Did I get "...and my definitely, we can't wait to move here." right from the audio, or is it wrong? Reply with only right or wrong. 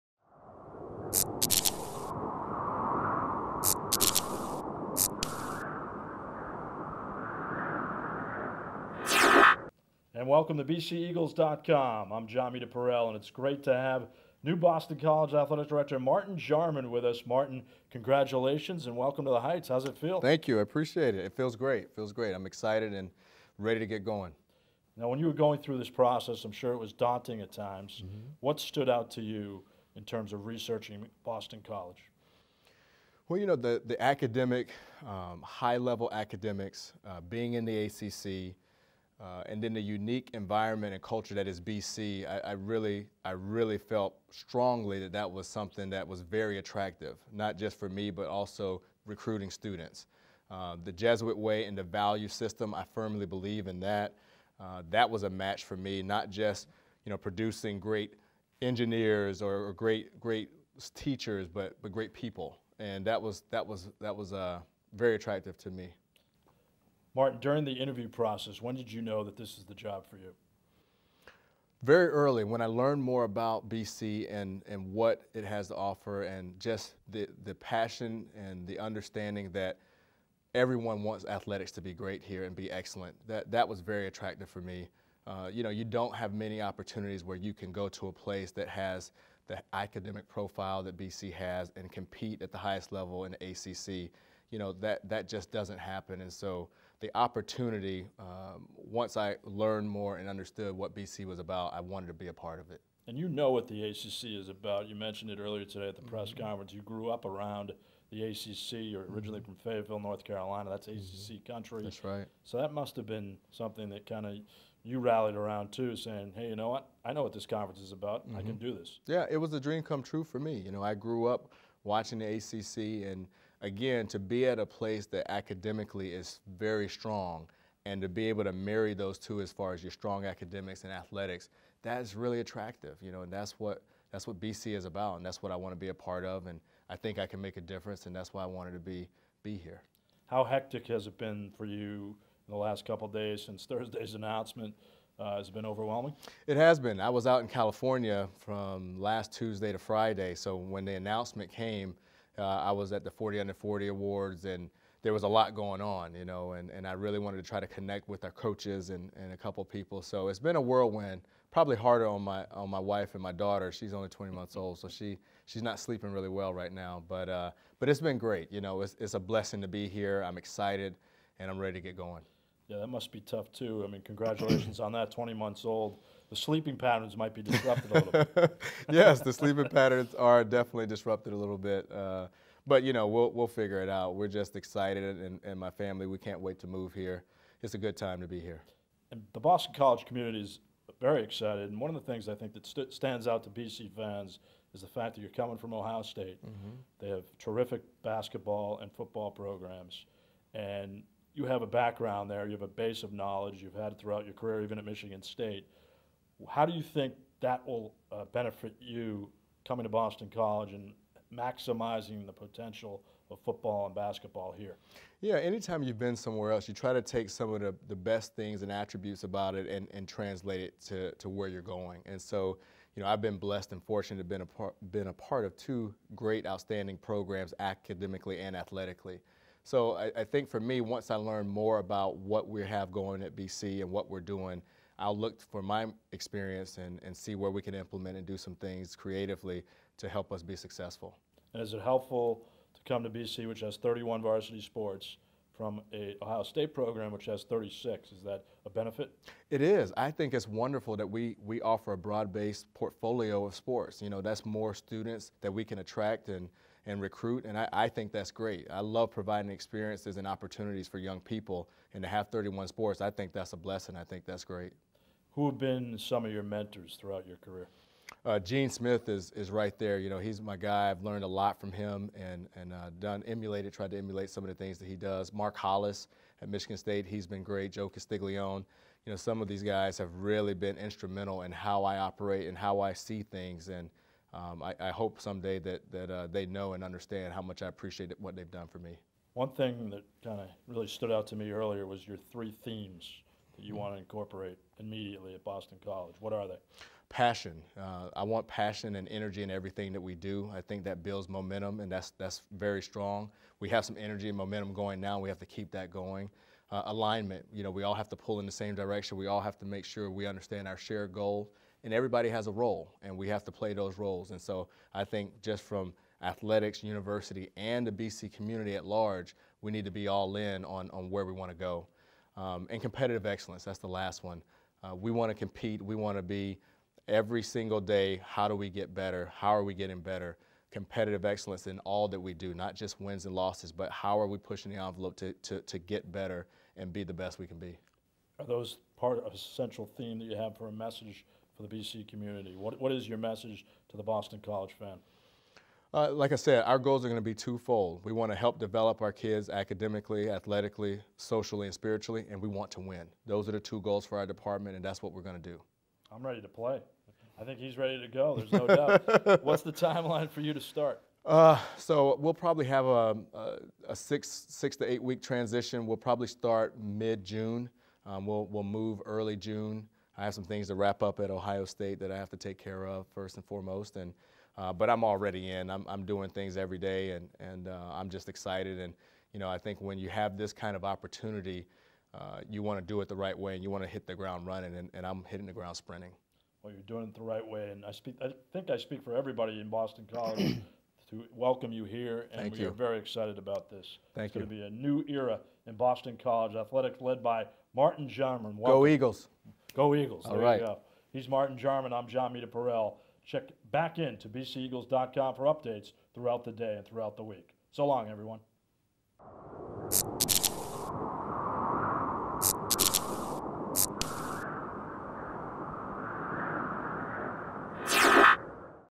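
wrong.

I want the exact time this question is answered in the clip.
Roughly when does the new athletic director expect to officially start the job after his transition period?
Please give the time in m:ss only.
6:06.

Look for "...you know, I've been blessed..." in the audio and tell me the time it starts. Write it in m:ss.
3:42.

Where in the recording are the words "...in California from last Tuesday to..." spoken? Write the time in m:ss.
2:27.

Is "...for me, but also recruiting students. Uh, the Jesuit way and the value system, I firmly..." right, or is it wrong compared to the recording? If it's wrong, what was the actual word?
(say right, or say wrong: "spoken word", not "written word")
right.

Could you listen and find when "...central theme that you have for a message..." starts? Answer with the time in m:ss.
5:39.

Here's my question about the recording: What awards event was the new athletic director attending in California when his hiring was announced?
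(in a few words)
40 Under 40 Awards.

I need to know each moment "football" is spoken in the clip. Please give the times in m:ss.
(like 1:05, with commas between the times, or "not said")
3:18, 3:33.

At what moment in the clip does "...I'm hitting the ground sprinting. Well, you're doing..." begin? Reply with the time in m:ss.
6:25.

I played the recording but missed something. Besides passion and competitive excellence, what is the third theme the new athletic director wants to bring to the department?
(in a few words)
Alignment.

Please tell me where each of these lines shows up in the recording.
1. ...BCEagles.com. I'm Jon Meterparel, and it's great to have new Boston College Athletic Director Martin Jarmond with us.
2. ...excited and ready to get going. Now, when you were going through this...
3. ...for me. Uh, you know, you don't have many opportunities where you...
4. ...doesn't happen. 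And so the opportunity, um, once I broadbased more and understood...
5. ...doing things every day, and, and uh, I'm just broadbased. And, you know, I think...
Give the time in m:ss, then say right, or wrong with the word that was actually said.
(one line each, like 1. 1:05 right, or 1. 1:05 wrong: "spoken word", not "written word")
1. 0:10 right
2. 0:22 right
3. 1:24 right
4. 1:35 wrong: "learned", not "broadbased"
5. 6:16 wrong: "excited", not "broadbased".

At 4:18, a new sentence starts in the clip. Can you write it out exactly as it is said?
I love providing experiences and opportunities for young people, and to have 31 sports, I think that's a blessing.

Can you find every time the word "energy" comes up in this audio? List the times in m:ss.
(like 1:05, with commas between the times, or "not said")
4:59, 5:03.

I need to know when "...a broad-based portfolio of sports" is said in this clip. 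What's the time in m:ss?
4:11.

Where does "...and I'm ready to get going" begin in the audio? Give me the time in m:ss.
2:51.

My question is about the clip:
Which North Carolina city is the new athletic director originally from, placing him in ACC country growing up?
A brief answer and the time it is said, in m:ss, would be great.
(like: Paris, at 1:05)
Fayetteville, at 1:49.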